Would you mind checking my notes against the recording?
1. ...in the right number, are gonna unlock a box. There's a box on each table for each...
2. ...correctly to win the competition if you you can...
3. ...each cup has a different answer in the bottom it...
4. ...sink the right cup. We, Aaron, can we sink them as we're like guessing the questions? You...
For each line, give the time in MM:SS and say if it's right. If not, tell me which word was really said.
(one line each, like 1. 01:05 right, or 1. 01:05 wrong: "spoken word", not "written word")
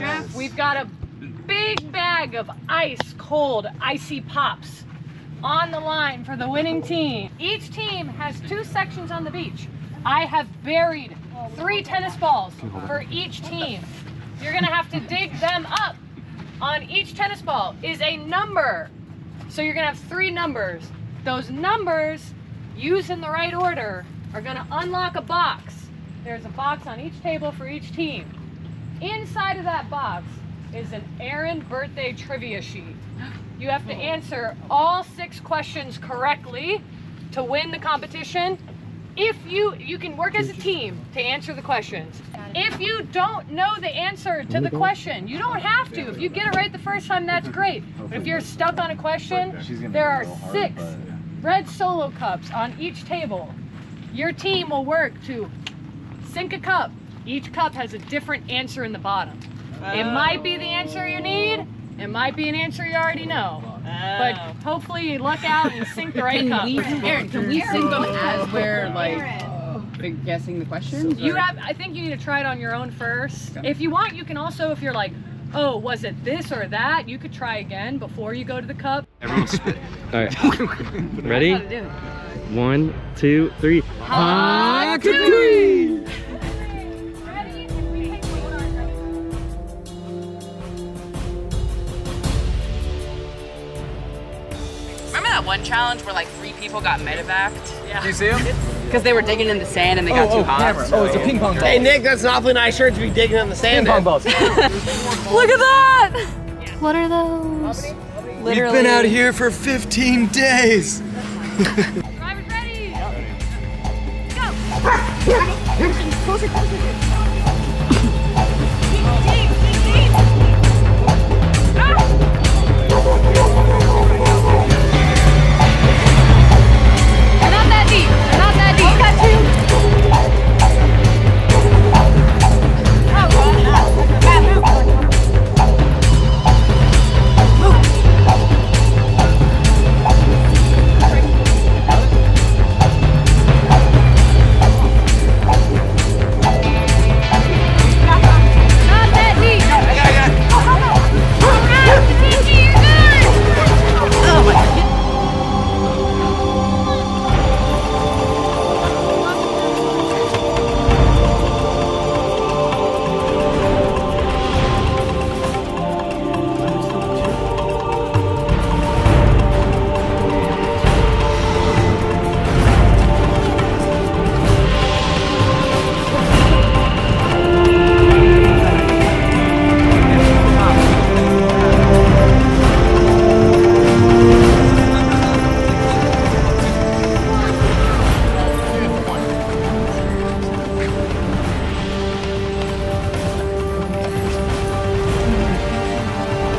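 1. 00:23 wrong: "order", not "number"
2. 00:35 right
3. 00:57 right
4. 01:05 right.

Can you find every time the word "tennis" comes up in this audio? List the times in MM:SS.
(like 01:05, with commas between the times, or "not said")
00:11, 00:17.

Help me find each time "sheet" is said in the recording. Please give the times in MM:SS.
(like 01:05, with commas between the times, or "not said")
00:32.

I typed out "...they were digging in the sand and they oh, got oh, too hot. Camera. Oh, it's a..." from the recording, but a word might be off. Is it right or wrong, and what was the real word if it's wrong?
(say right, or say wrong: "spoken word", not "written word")
right.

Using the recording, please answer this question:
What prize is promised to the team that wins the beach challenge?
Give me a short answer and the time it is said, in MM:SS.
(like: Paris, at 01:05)
Ice cold icy pops, at 00:02.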